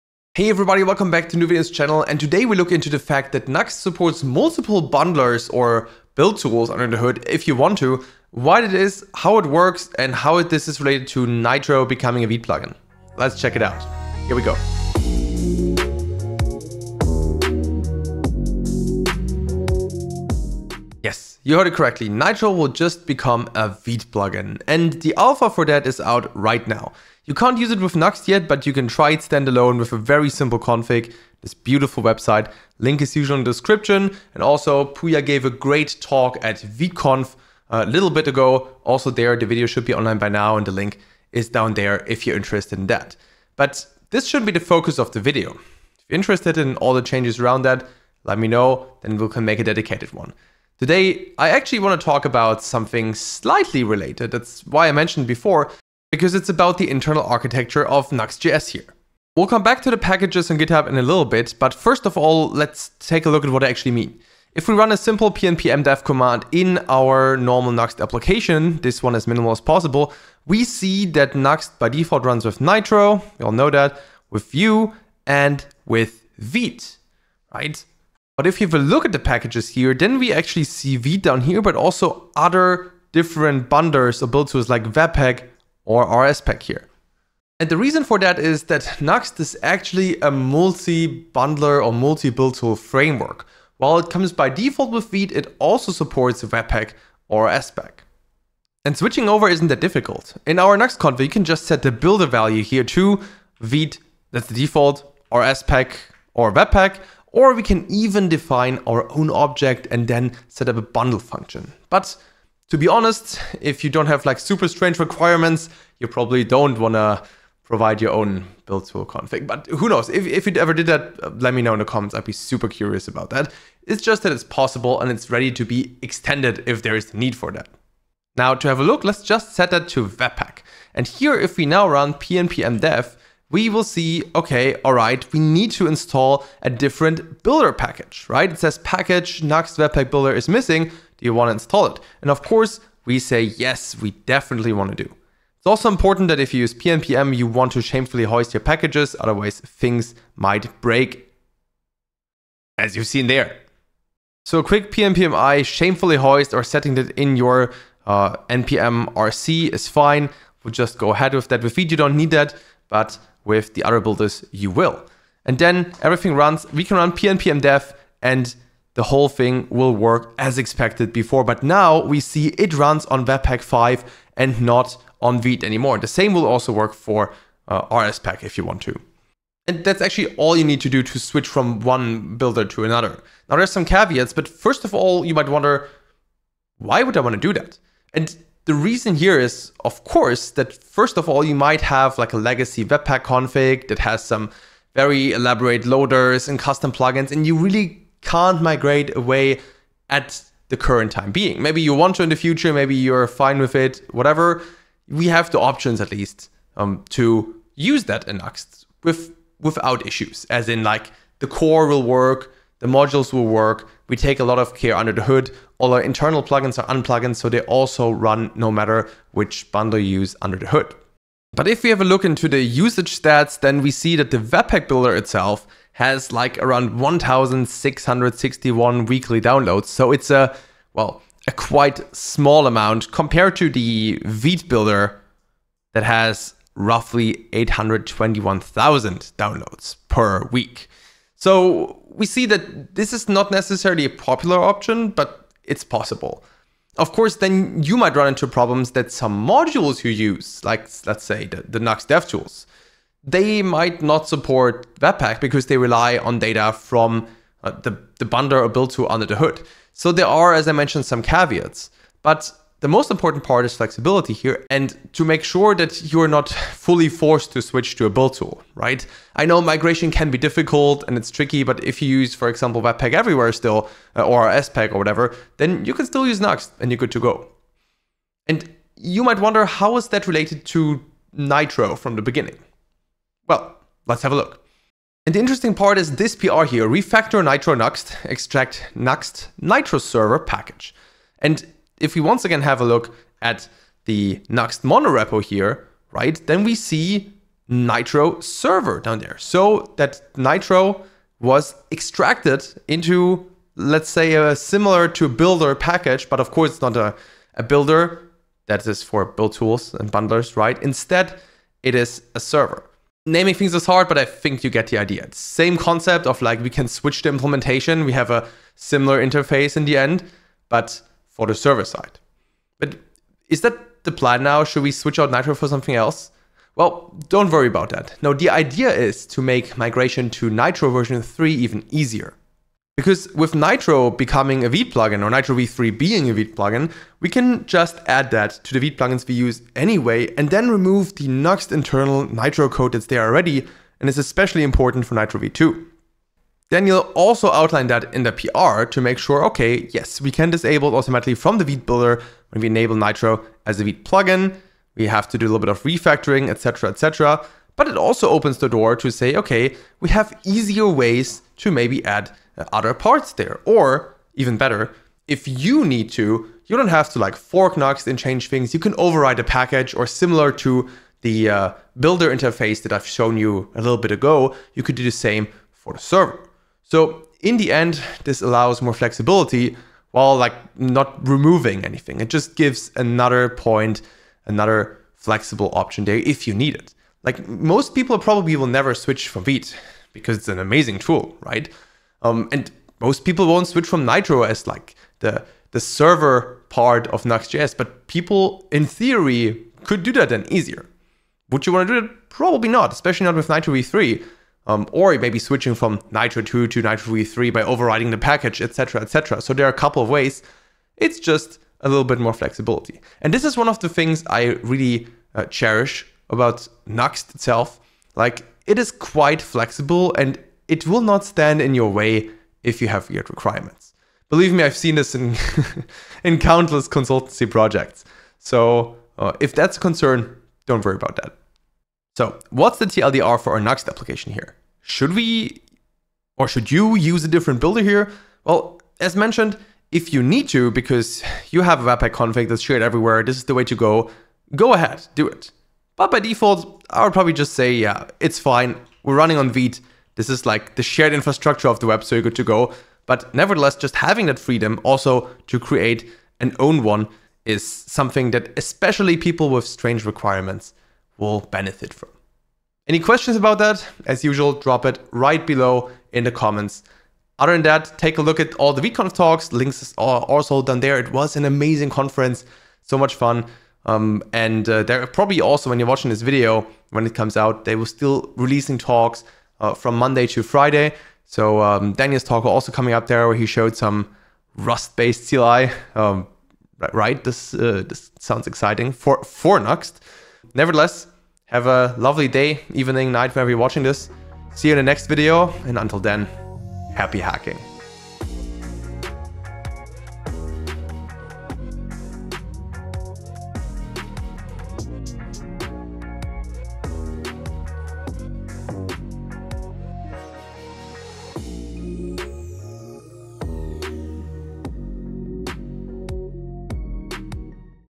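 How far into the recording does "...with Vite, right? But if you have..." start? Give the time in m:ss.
1:15.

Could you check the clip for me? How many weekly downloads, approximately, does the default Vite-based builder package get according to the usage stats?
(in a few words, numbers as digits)
821,000.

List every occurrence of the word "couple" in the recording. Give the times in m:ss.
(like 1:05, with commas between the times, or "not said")
6:49.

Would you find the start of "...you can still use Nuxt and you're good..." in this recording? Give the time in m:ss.
4:35.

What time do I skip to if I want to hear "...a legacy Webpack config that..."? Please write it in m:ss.
3:12.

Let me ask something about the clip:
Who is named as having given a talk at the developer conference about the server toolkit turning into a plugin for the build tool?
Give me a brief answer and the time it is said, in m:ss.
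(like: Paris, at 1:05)
Pooya, at 0:34.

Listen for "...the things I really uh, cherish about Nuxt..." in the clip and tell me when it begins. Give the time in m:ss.
6:53.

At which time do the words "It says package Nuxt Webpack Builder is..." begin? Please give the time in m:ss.
2:18.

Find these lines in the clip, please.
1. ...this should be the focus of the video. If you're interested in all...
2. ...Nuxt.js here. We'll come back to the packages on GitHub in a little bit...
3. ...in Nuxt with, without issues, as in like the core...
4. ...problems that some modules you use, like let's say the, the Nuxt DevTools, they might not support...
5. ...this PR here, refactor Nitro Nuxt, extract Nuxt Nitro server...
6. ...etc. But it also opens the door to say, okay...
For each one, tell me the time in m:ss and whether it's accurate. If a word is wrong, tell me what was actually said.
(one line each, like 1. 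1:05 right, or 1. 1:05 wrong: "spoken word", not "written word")
1. 0:44 right
2. 0:58 right
3. 3:28 right
4. 4:08 right
5. 4:46 right
6. 5:56 right.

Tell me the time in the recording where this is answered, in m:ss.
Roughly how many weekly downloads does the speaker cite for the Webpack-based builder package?
3:46.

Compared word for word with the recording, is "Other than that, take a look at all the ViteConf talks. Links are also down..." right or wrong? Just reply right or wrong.
right.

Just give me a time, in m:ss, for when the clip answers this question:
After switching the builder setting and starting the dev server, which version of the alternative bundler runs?
2:53.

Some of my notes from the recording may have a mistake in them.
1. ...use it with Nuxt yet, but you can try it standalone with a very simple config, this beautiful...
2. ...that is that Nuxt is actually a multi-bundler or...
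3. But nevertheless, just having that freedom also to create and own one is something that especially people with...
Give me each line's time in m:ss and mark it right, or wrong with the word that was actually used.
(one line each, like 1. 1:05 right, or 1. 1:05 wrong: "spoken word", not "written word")
1. 0:27 right
2. 1:28 right
3. 7:33 right.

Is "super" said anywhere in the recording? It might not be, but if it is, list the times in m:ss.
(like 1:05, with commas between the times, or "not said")
1:54, 2:02.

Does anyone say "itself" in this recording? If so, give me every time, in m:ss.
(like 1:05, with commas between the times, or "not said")
3:45, 6:57.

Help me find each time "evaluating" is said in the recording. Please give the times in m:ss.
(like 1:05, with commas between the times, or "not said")
not said.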